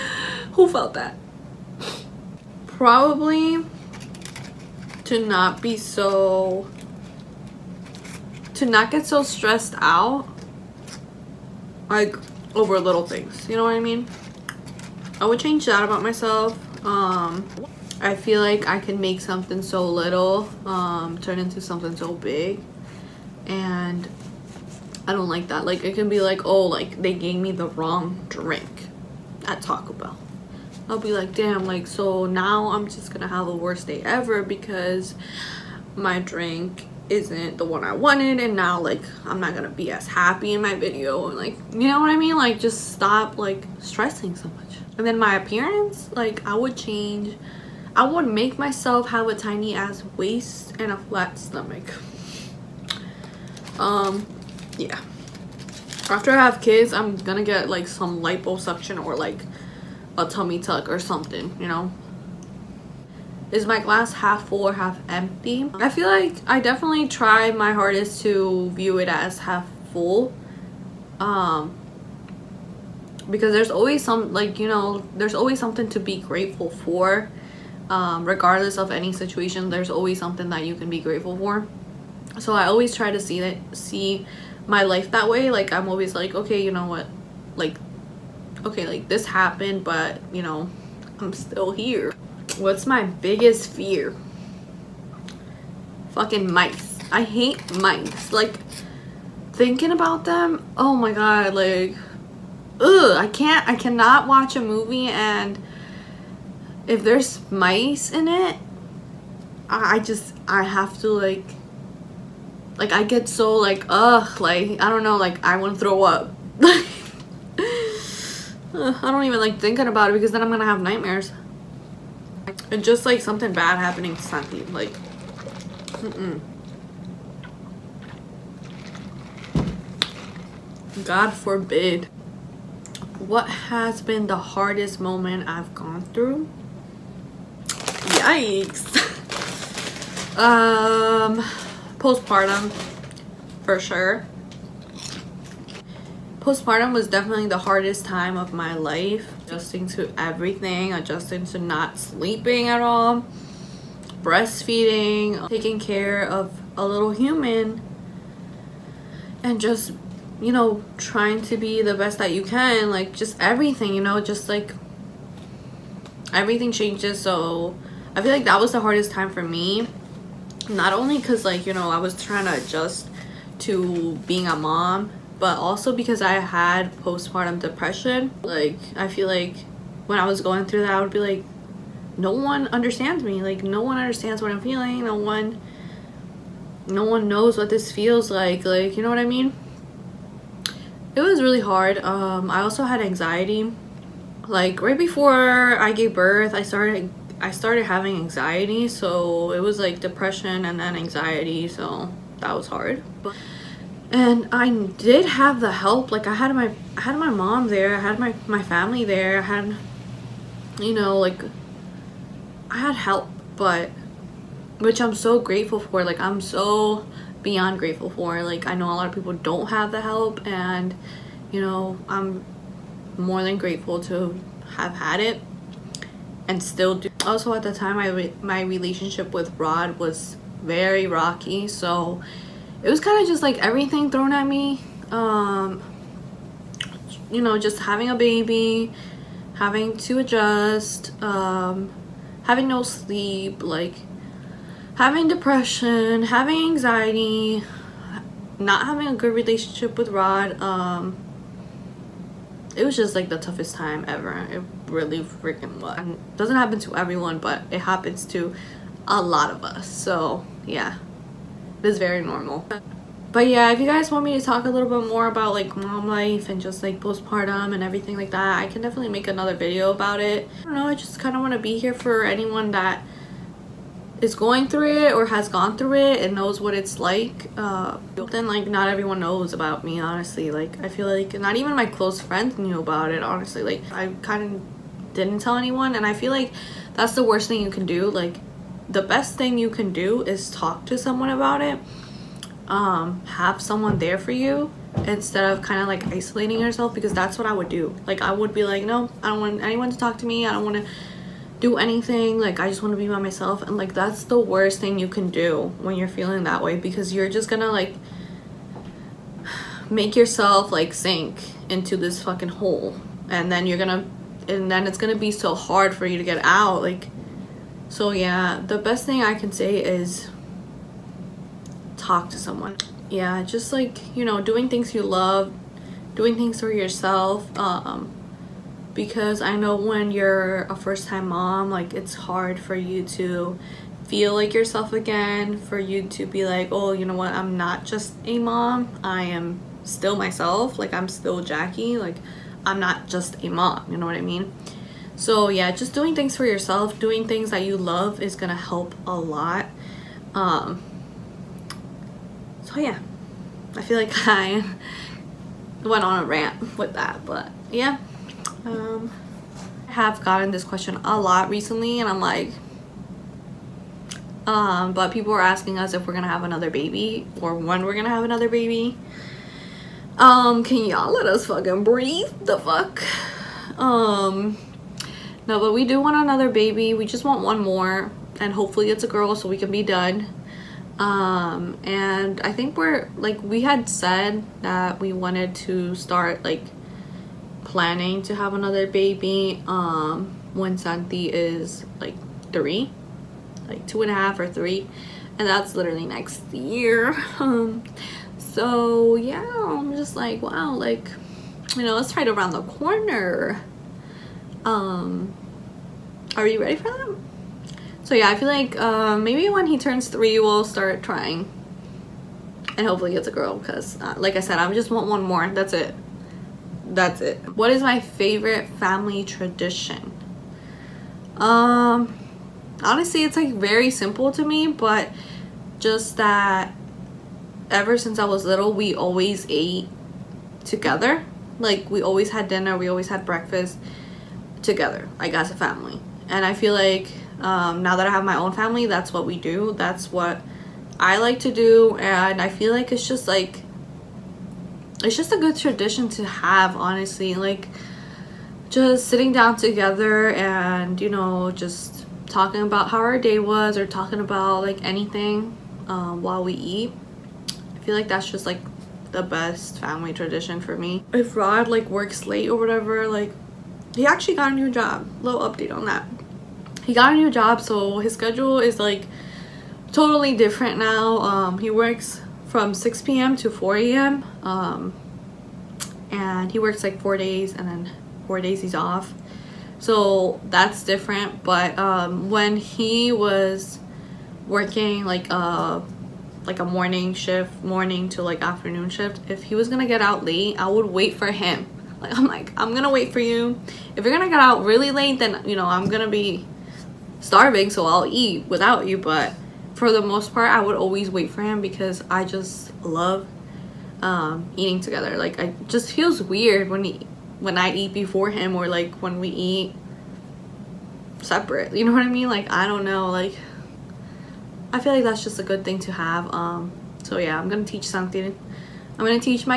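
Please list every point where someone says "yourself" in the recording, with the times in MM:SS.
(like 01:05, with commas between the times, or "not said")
04:56, 05:10, 05:26, 05:34, 05:46.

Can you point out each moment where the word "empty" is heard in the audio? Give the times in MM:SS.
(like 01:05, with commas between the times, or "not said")
01:05.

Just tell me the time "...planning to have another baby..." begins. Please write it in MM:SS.
06:27.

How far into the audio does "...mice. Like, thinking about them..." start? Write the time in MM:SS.
01:37.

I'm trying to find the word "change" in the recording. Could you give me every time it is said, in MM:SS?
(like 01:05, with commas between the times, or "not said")
00:15, 00:46, 02:46.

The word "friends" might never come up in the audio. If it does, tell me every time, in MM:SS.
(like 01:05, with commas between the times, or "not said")
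04:42.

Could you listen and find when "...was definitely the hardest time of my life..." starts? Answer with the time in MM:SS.
02:26.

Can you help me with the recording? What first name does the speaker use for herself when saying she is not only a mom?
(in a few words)
Jackie.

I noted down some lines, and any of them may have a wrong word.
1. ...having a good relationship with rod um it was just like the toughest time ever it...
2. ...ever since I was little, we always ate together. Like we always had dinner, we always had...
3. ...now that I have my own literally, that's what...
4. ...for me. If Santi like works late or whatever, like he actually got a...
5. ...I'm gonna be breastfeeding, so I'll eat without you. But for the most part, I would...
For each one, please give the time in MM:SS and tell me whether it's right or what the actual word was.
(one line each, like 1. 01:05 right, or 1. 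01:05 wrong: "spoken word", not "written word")
1. 04:08 right
2. 07:07 right
3. 07:17 wrong: "family", not "literally"
4. 07:40 wrong: "Rod", not "Santi"
5. 08:15 wrong: "starving", not "breastfeeding".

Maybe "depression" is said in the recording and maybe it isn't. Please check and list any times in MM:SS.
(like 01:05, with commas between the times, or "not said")
02:57, 03:20, 04:05.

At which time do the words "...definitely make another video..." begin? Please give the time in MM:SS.
04:28.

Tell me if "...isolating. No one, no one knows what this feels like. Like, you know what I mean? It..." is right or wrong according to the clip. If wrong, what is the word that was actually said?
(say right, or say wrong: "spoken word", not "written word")
wrong: "feeling", not "isolating".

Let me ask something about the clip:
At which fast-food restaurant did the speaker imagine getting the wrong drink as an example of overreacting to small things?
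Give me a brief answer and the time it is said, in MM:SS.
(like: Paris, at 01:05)
Taco Bell, at 00:29.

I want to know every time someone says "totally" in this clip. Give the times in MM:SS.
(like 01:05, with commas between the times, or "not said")
07:49.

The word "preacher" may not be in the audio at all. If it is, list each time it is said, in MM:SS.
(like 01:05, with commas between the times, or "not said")
not said.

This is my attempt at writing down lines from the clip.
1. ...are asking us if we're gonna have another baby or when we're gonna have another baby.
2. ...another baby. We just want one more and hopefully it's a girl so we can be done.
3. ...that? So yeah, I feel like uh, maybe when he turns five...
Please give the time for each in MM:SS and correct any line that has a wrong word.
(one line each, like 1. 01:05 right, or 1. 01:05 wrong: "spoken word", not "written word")
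1. 06:05 right
2. 06:16 right
3. 06:46 wrong: "three", not "five".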